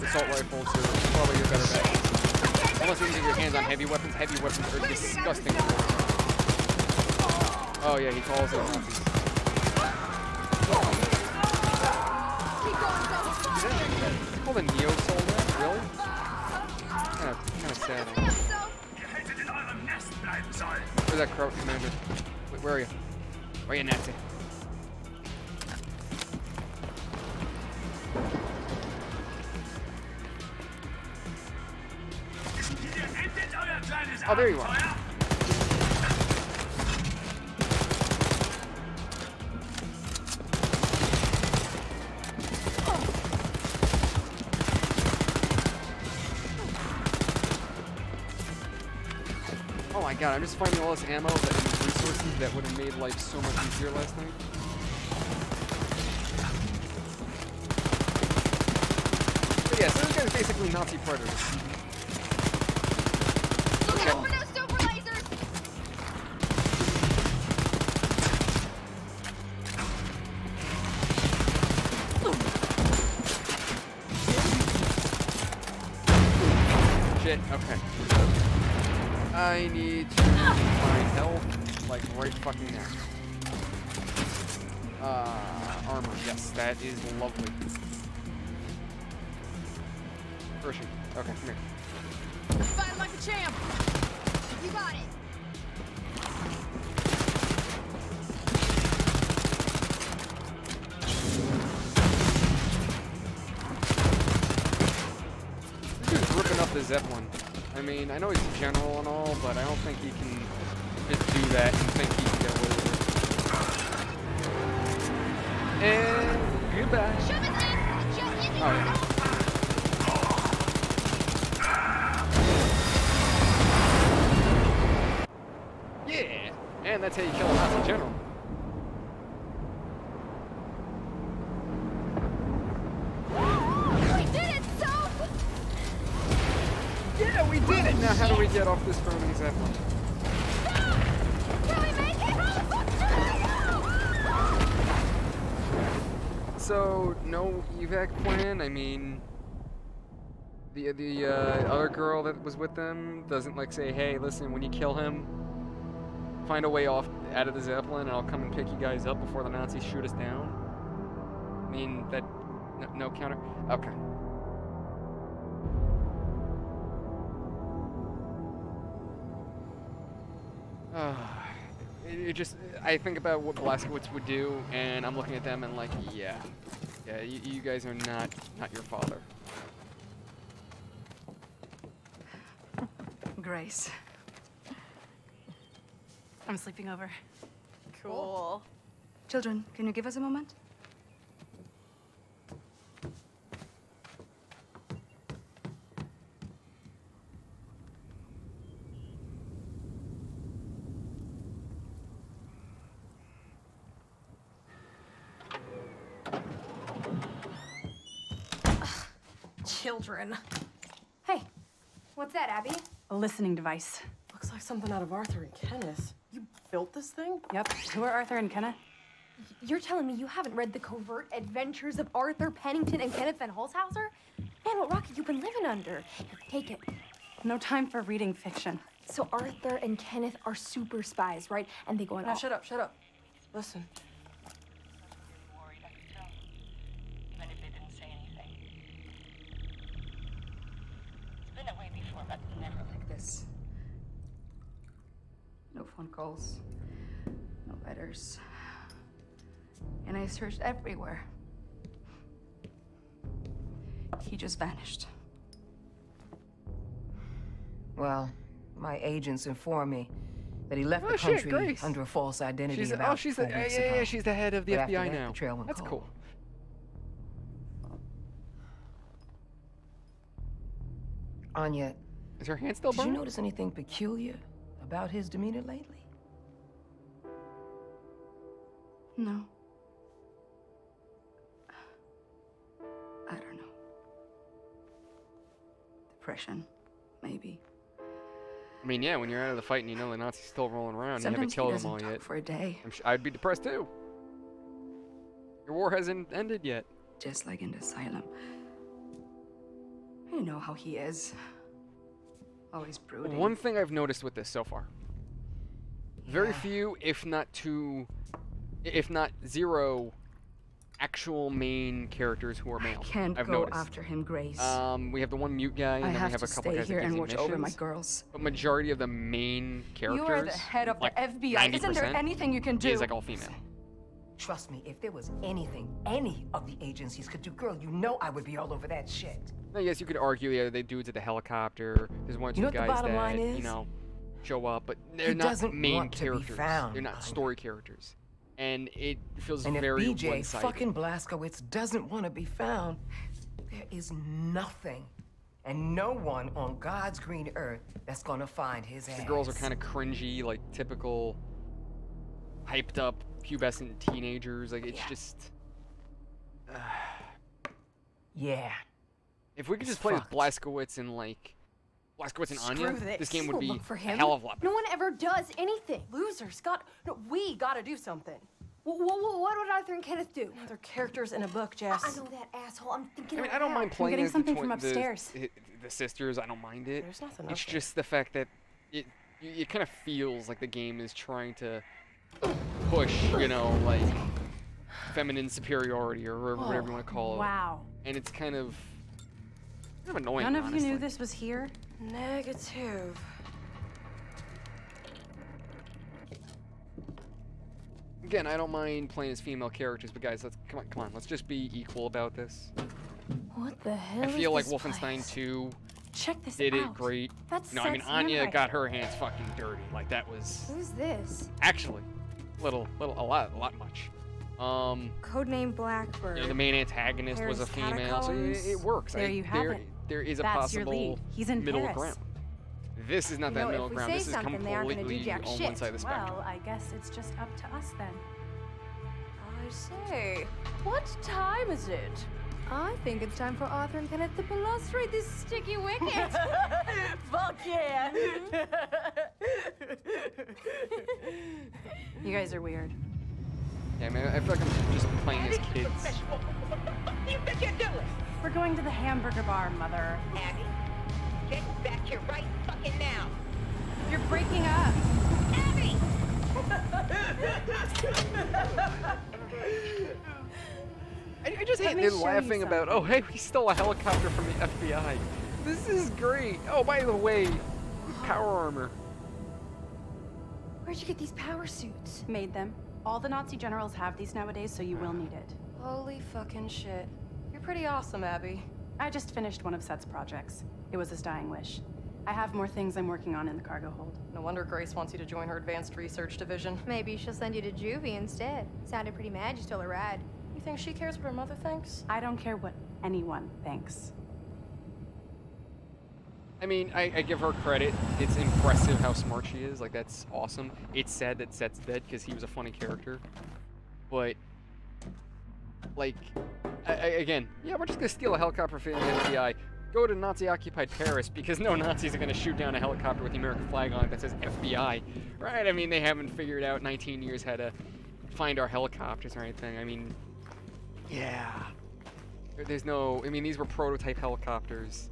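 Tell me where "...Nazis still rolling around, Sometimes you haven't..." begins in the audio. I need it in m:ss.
4:50.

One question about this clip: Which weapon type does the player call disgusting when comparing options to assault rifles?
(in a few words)
Heavy weapons.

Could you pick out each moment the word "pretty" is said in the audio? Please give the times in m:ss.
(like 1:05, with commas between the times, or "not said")
7:57, 8:09.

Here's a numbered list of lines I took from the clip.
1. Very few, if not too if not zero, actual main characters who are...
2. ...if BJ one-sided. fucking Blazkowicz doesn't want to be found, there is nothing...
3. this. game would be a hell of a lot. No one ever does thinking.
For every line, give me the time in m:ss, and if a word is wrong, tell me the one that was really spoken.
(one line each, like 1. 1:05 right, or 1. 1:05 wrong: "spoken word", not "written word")
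1. 5:06 right
2. 5:40 right
3. 6:03 wrong: "anything", not "thinking".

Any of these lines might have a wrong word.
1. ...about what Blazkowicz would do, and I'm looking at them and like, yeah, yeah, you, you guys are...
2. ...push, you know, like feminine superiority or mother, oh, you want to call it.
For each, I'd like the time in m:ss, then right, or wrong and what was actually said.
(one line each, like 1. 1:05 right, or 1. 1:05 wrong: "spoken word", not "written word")
1. 2:53 right
2. 6:22 wrong: "whatever", not "mother".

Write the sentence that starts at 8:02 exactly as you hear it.
I have more things I'm working on in the cargo hold.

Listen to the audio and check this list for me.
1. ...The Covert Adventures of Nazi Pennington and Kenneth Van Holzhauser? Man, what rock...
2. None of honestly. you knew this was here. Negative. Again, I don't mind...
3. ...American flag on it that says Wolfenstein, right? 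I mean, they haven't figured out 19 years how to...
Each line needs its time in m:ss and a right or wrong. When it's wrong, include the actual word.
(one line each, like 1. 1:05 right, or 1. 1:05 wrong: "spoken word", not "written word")
1. 3:40 wrong: "Arthur", not "Nazi"
2. 6:30 right
3. 8:33 wrong: "FBI", not "Wolfenstein".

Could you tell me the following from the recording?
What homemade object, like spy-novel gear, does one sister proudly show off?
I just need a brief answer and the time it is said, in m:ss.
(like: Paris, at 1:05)
A listening device, at 3:33.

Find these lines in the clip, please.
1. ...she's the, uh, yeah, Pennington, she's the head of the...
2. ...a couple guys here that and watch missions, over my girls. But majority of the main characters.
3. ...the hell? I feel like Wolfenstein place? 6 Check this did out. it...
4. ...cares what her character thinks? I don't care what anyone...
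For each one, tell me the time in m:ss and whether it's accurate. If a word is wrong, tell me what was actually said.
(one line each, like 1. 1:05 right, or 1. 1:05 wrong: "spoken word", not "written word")
1. 4:23 wrong: "Yeah", not "Pennington"
2. 5:16 right
3. 6:43 wrong: "2", not "6"
4. 8:10 wrong: "mother", not "character".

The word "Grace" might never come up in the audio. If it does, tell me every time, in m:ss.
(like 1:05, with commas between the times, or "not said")
3:03, 5:14, 8:04.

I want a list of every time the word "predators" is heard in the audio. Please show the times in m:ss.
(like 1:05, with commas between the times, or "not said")
1:00.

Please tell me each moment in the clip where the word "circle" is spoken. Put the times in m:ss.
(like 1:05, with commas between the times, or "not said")
not said.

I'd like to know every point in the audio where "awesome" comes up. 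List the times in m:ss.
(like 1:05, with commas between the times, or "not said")
7:57, 8:20.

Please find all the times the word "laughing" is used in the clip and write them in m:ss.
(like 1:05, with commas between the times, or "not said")
7:42.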